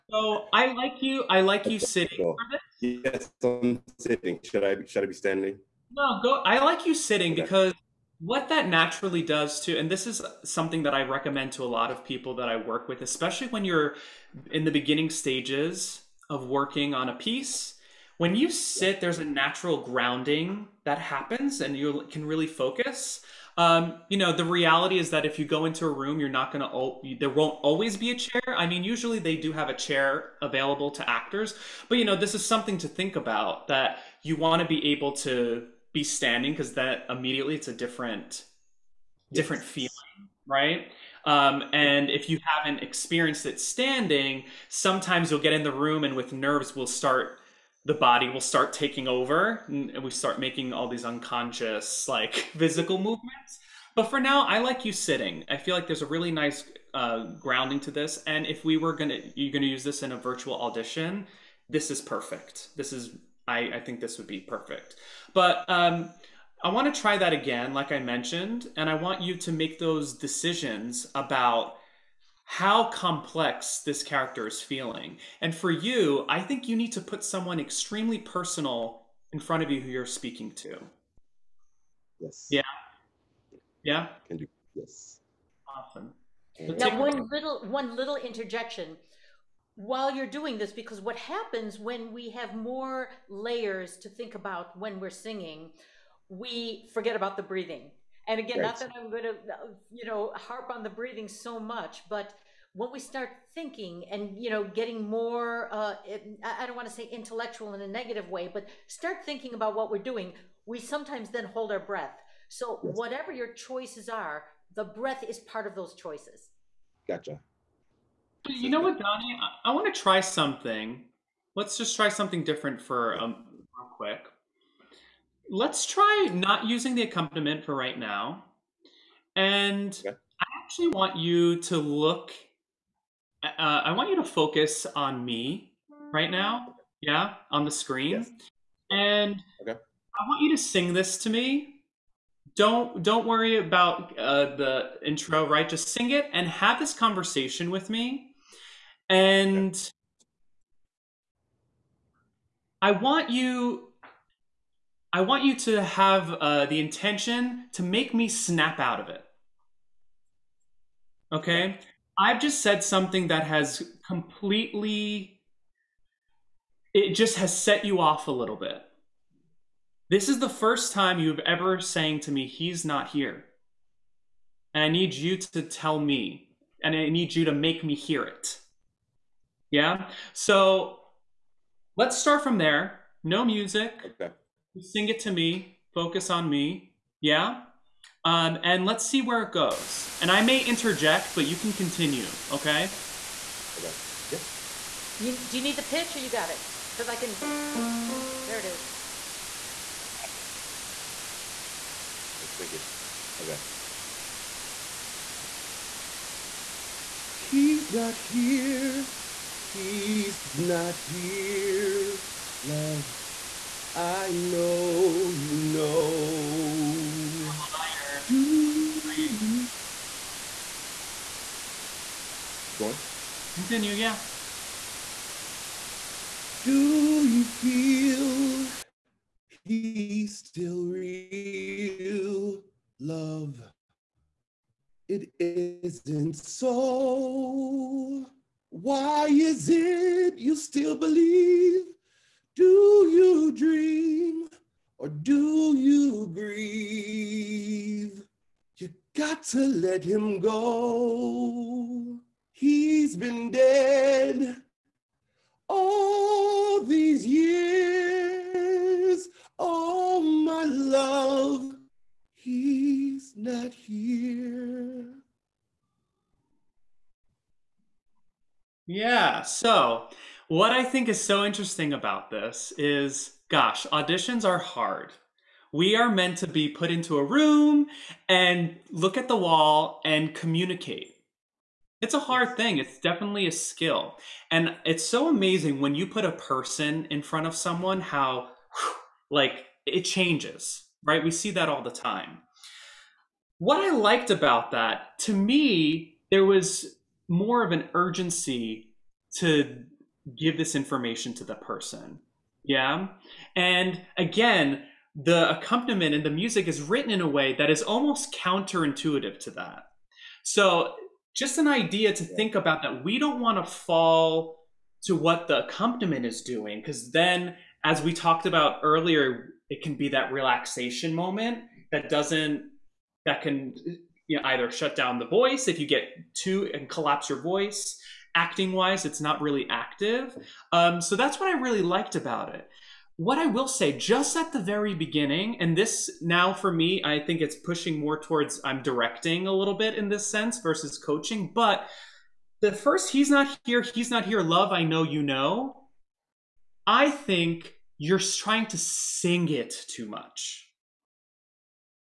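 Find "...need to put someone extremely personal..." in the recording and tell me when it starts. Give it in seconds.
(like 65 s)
76 s.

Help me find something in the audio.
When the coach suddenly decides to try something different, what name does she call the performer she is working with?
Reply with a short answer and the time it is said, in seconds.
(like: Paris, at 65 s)
Dony, at 118 s.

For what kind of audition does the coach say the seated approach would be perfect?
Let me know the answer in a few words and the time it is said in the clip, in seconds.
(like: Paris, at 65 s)
Virtual, at 60 s.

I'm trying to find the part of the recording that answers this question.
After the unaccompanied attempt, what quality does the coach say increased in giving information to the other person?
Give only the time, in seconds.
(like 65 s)
297 s.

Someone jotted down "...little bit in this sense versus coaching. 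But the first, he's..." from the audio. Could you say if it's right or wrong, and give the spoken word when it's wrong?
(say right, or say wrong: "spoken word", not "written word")
right.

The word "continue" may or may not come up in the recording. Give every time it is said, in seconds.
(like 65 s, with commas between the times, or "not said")
191 s, 223 s.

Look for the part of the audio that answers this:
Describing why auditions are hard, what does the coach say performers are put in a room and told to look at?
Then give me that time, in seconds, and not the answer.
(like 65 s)
279 s.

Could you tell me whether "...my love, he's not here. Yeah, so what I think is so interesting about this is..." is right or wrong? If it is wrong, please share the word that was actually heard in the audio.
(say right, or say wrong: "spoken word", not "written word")
right.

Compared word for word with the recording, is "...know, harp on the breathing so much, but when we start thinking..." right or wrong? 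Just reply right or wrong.
right.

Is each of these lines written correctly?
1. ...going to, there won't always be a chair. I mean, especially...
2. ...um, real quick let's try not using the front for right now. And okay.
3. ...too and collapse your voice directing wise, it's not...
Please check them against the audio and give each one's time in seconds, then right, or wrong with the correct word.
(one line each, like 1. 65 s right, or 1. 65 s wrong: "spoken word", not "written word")
1. 26 s wrong: "usually", not "especially"
2. 123 s wrong: "accompaniment", not "front"
3. 326 s wrong: "acting", not "directing".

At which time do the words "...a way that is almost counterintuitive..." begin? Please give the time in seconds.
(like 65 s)
307 s.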